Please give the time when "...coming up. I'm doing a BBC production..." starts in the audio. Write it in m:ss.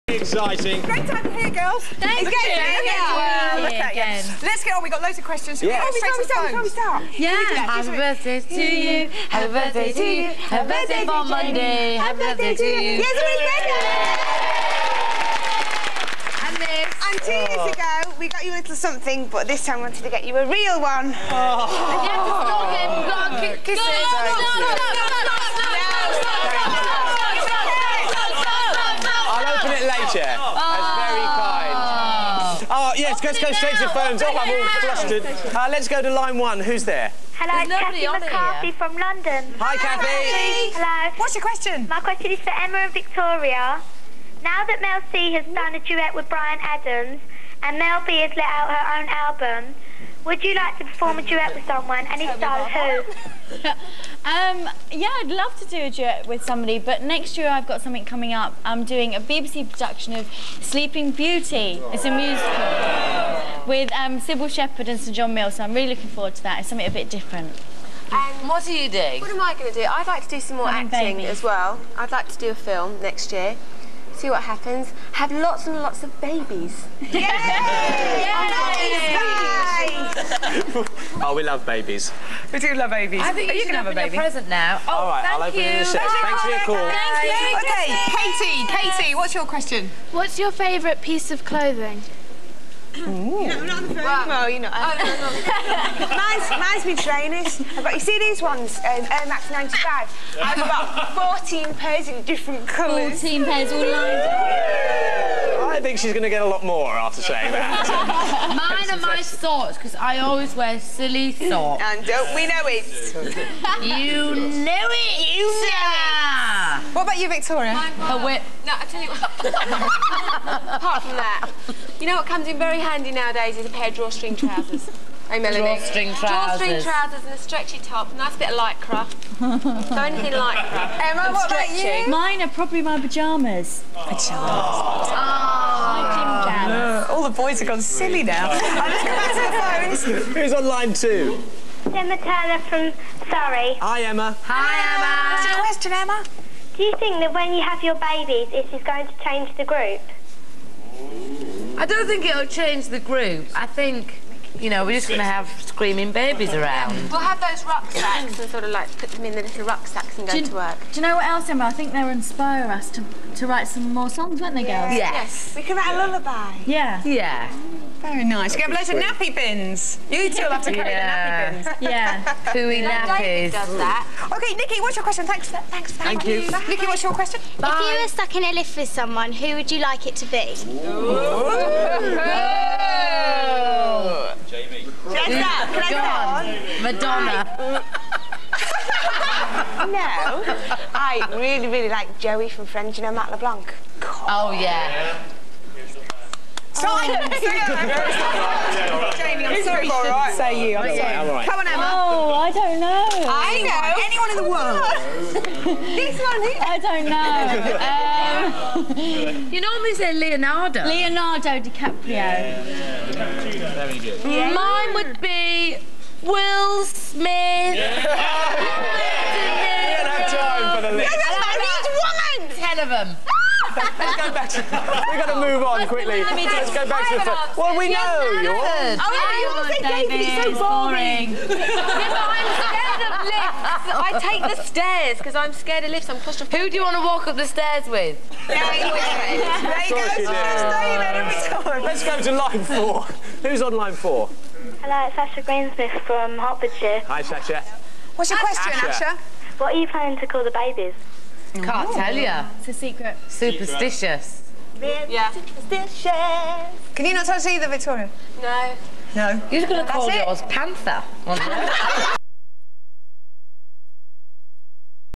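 0:58.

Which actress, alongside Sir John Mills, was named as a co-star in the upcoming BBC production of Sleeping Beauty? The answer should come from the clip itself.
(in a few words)
Cybill Shepherd.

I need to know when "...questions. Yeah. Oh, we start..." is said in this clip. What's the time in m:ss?
0:05.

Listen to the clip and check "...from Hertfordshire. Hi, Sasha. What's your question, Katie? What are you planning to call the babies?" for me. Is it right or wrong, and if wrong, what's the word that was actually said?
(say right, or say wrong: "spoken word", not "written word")
wrong: "Asha", not "Katie".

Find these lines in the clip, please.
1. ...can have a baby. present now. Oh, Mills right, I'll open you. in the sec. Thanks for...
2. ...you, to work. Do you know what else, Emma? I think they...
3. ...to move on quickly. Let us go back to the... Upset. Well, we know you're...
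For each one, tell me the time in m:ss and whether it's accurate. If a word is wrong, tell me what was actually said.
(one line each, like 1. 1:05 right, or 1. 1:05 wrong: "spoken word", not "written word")
1. 1:23 wrong: "All", not "Mills"
2. 2:40 right
3. 3:45 right.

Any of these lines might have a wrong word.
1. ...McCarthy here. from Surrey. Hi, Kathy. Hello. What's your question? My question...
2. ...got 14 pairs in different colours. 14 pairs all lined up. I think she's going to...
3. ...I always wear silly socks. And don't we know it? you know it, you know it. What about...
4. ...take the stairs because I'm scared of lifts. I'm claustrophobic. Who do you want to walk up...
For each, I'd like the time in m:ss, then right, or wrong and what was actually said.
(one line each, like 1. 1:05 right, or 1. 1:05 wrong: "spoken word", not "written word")
1. 0:38 wrong: "London", not "Surrey"
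2. 1:40 right
3. 1:49 right
4. 3:54 right.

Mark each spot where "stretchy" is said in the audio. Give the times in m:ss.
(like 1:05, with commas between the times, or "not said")
2:07, 2:11.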